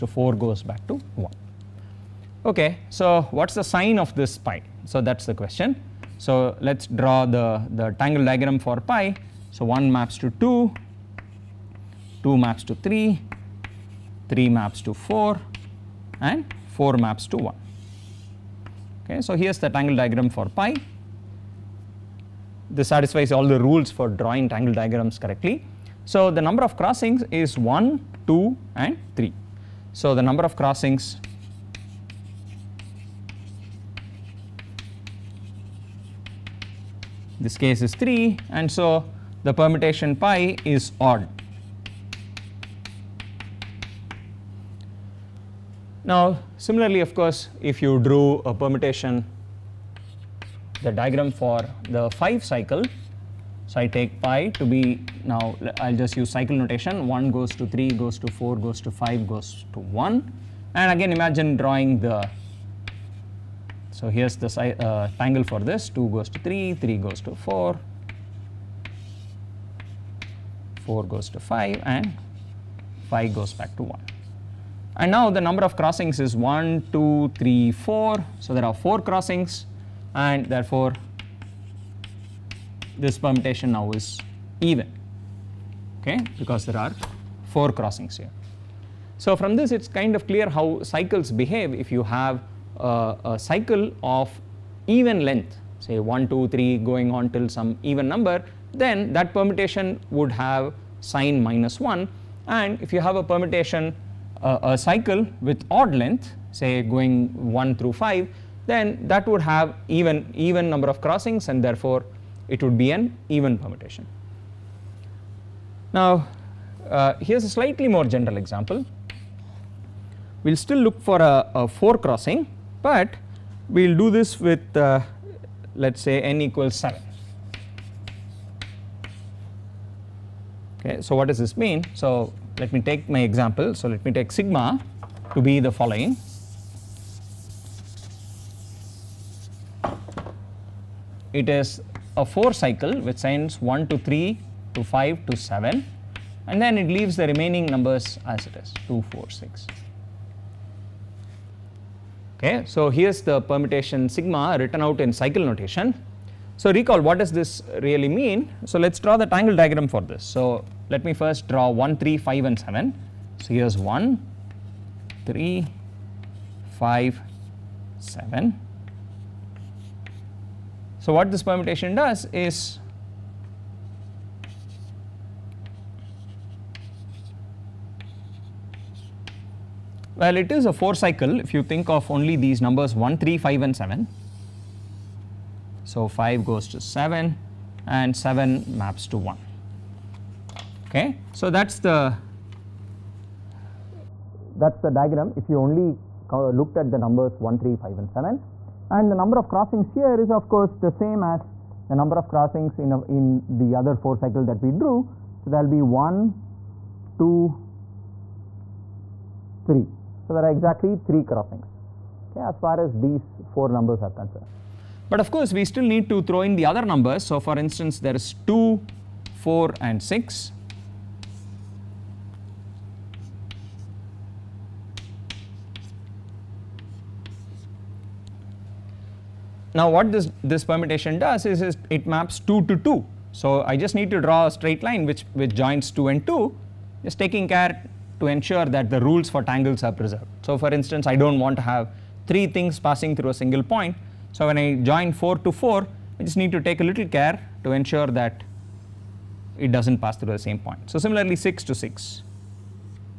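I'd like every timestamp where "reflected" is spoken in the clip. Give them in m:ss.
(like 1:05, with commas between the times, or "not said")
not said.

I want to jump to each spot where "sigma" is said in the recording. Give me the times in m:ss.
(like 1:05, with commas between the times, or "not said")
2:14, 2:34.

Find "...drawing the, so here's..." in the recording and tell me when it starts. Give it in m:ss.
1:01.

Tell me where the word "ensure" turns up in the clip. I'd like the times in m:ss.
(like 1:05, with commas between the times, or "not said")
3:58, 4:07.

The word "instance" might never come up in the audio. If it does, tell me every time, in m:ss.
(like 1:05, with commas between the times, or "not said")
3:37, 4:00.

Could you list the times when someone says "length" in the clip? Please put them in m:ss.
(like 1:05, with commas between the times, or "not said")
1:35, 1:45.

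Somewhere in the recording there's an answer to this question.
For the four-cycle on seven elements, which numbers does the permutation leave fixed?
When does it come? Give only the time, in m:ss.
2:28.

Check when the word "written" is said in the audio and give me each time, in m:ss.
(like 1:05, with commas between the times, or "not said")
2:34.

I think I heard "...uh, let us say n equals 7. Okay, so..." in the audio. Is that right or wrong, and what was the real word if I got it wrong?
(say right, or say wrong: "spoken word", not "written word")
right.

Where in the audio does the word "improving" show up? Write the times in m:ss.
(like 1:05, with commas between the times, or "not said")
not said.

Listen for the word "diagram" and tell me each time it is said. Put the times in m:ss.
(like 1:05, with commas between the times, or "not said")
0:08, 0:19, 0:24, 0:50, 2:39, 3:14.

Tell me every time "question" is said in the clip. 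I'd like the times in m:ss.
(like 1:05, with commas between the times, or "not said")
0:05.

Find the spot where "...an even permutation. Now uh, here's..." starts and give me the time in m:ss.
1:52.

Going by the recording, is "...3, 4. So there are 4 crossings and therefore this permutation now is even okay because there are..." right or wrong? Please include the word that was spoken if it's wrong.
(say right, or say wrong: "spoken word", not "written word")
right.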